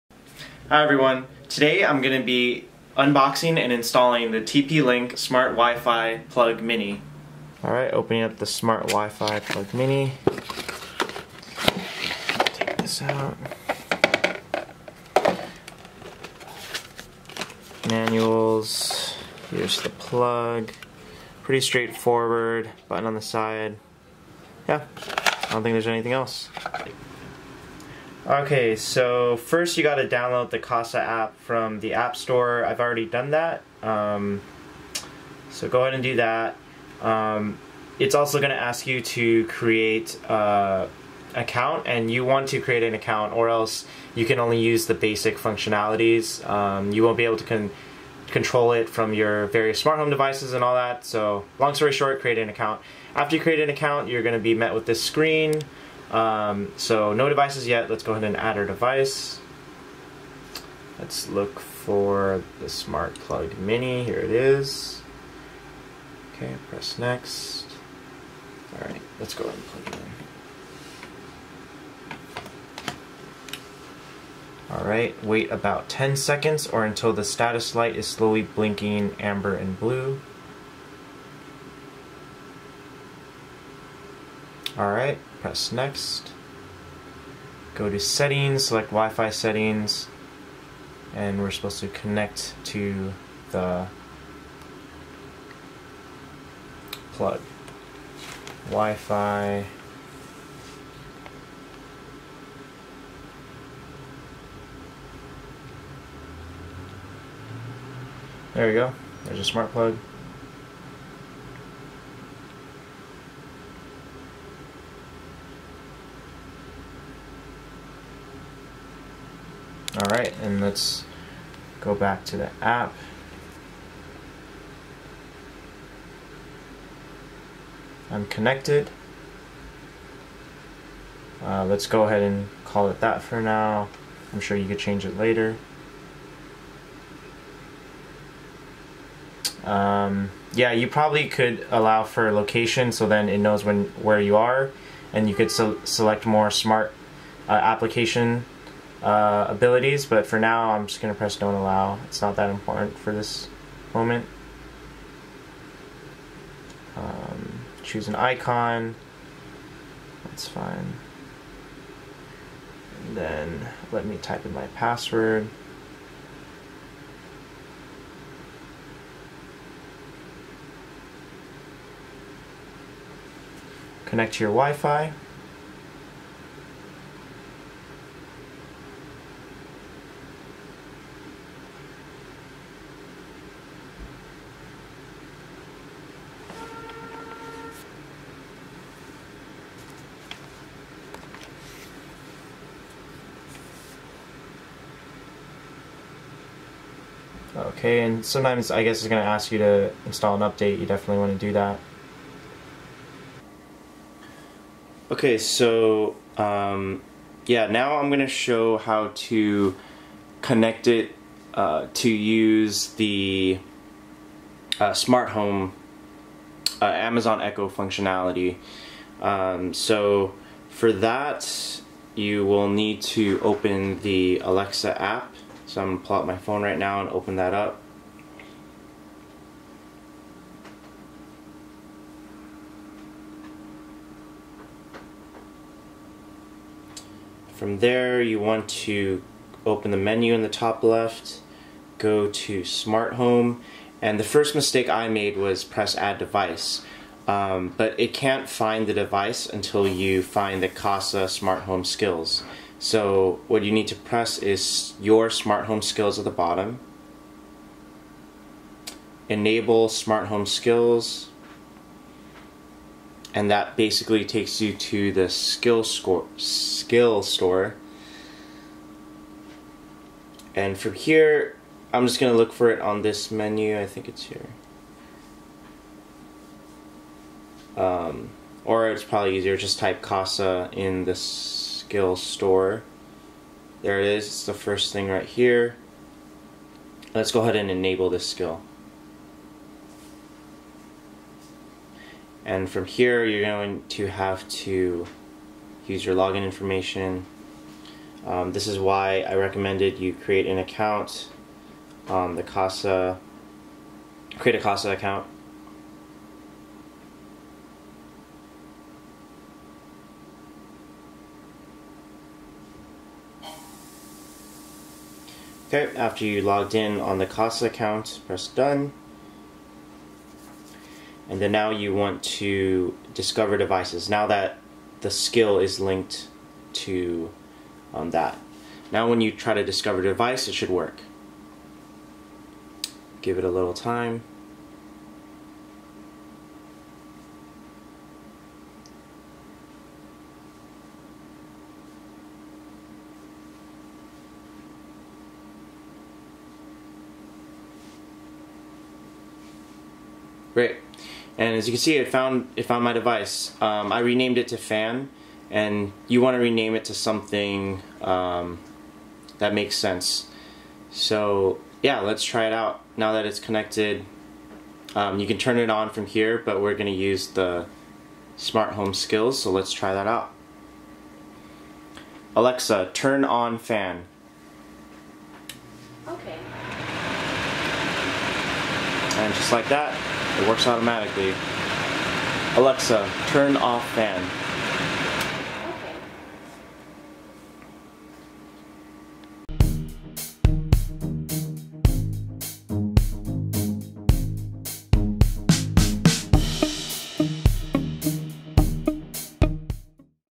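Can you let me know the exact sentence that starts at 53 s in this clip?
After you create an account, you're going to be met with this screen.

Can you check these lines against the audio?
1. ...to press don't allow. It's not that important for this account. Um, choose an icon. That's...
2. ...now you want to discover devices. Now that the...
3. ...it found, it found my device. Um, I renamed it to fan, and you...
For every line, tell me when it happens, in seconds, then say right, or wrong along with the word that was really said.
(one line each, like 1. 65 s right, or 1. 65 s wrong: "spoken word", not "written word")
1. 151 s wrong: "moment", not "account"
2. 321 s right
3. 351 s right.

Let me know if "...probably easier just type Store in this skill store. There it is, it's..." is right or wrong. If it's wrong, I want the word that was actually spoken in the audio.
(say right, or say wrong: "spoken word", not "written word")
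wrong: "Kasa", not "Store".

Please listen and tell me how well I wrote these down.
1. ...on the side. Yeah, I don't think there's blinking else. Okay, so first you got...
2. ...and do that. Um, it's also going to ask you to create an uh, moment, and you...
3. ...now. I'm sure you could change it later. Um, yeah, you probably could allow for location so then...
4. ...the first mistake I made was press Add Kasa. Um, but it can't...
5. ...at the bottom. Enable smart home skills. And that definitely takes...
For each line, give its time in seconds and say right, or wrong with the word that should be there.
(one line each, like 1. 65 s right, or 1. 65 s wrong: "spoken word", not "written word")
1. 23 s wrong: "anything", not "blinking"
2. 35 s wrong: "account", not "moment"
3. 133 s right
4. 244 s wrong: "Device", not "Kasa"
5. 256 s wrong: "basically", not "definitely".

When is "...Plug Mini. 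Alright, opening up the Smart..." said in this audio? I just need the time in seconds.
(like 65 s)
6 s.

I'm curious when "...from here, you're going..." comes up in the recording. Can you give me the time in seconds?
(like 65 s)
292 s.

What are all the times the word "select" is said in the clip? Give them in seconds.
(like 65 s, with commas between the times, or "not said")
88 s, 145 s.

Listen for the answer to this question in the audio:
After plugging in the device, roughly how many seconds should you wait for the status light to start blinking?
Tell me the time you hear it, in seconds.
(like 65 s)
75 s.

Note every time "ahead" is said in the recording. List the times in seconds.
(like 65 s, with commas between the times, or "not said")
35 s, 58 s, 69 s, 132 s, 287 s.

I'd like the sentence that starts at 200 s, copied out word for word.
You definitely want to do that.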